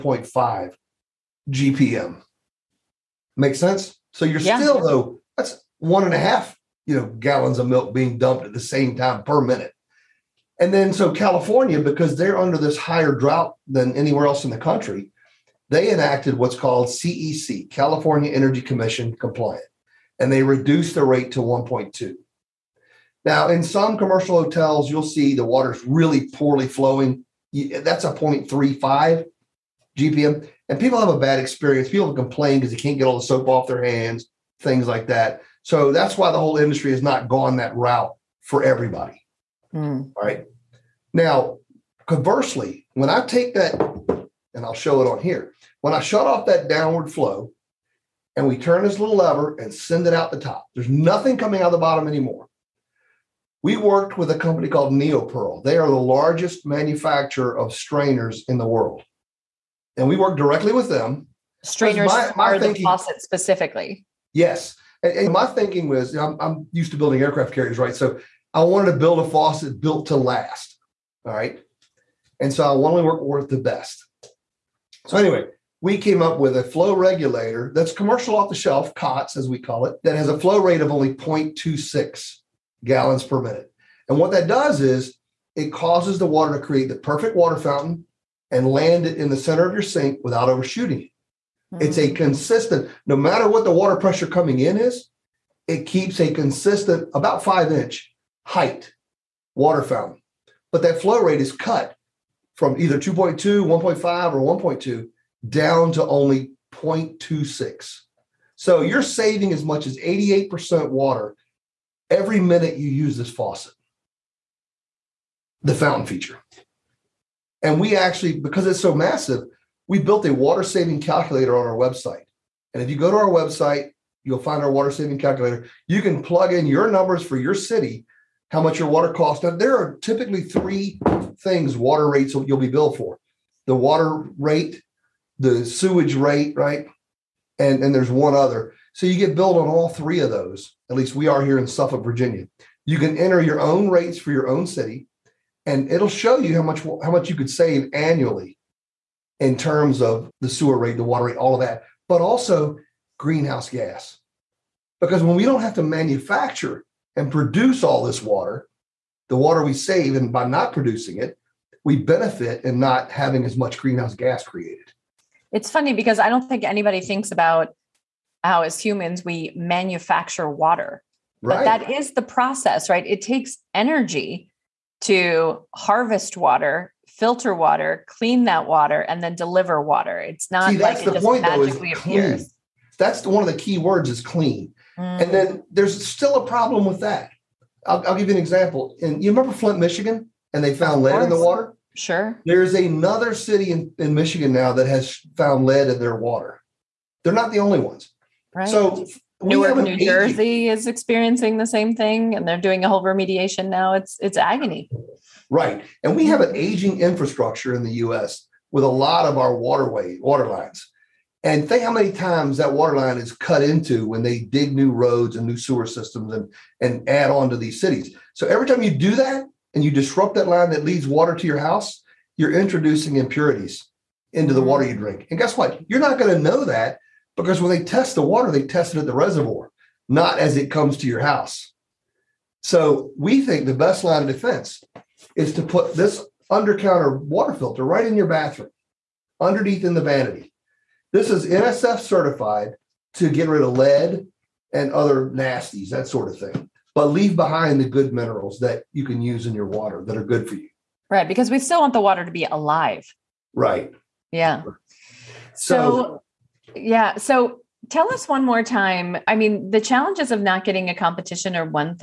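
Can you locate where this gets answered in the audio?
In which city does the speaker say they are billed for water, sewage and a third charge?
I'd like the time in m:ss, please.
2:21.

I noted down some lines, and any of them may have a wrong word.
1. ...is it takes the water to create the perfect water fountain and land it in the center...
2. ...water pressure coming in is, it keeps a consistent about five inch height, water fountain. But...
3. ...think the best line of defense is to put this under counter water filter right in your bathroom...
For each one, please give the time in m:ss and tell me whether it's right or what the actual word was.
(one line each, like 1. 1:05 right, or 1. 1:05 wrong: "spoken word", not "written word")
1. 1:24 wrong: "causes", not "takes"
2. 1:33 right
3. 3:53 right.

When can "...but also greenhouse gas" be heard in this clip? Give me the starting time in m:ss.
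2:32.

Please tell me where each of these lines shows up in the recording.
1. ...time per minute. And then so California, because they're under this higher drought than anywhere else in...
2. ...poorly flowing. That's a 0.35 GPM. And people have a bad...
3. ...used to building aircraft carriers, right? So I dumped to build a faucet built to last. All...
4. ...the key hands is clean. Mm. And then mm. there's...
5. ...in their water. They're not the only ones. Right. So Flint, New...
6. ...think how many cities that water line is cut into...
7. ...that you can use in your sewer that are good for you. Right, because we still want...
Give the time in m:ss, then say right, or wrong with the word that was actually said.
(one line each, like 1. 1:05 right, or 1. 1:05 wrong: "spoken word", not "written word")
1. 0:08 right
2. 0:26 right
3. 1:06 wrong: "wanted", not "dumped"
4. 3:03 wrong: "words", not "hands"
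5. 3:15 wrong: "Newark", not "Flint"
6. 3:31 wrong: "times", not "cities"
7. 4:08 wrong: "water", not "sewer".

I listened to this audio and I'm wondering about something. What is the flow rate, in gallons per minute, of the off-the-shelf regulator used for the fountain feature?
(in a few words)
0.26.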